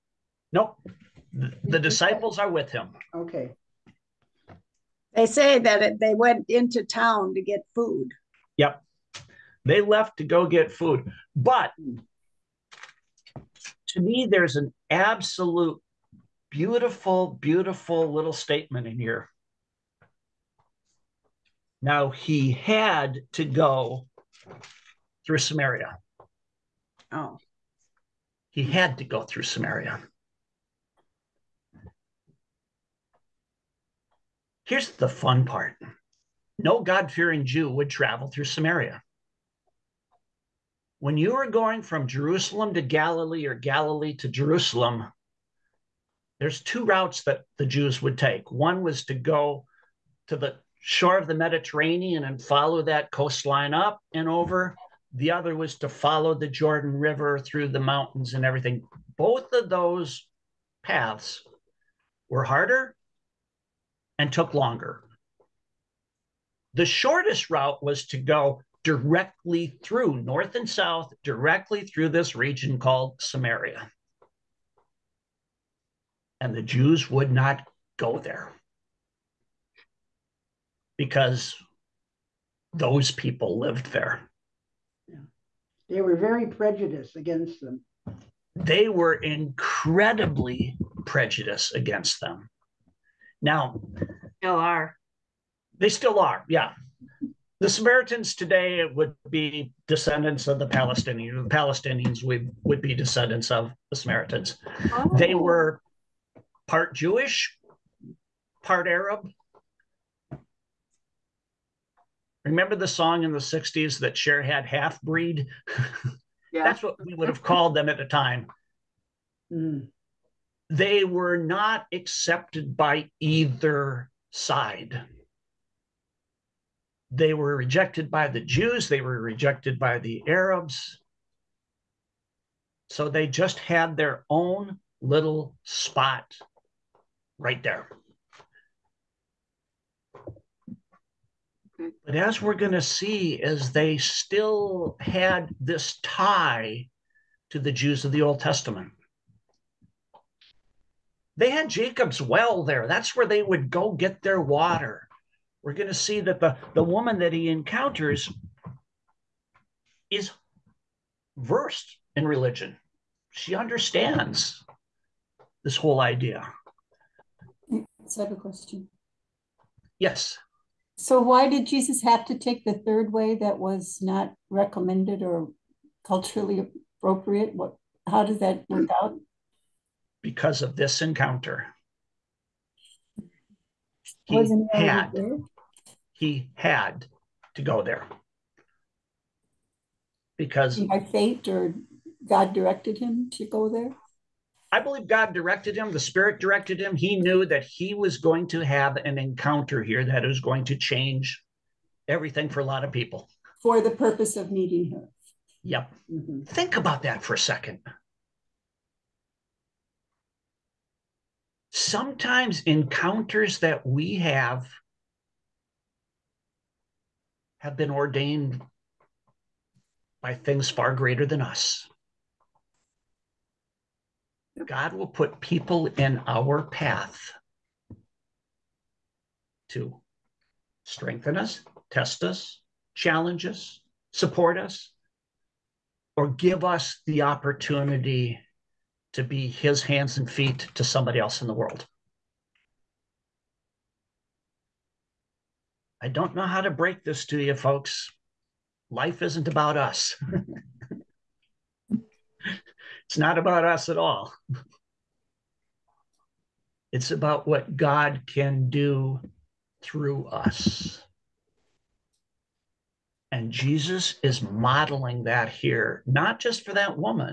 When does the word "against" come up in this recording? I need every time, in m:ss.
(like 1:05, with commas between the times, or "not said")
1:27, 1:31.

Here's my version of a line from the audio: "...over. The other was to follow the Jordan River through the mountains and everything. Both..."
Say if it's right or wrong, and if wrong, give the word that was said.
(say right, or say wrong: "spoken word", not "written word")
right.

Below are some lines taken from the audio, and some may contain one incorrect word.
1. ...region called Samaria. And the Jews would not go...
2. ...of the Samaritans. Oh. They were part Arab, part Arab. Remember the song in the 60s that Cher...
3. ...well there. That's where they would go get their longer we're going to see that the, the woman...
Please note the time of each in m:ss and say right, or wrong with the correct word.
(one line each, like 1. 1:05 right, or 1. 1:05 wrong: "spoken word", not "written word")
1. 1:12 right
2. 1:43 wrong: "Jewish", not "Arab"
3. 2:32 wrong: "water", not "longer".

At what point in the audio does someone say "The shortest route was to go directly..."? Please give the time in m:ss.
1:06.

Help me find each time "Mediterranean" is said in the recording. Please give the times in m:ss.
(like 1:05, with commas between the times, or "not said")
0:51.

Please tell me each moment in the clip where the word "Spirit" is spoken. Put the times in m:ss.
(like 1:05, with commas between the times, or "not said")
3:15.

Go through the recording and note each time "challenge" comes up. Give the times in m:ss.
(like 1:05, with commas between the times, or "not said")
3:52.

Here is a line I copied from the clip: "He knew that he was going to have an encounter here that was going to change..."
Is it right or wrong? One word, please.
right.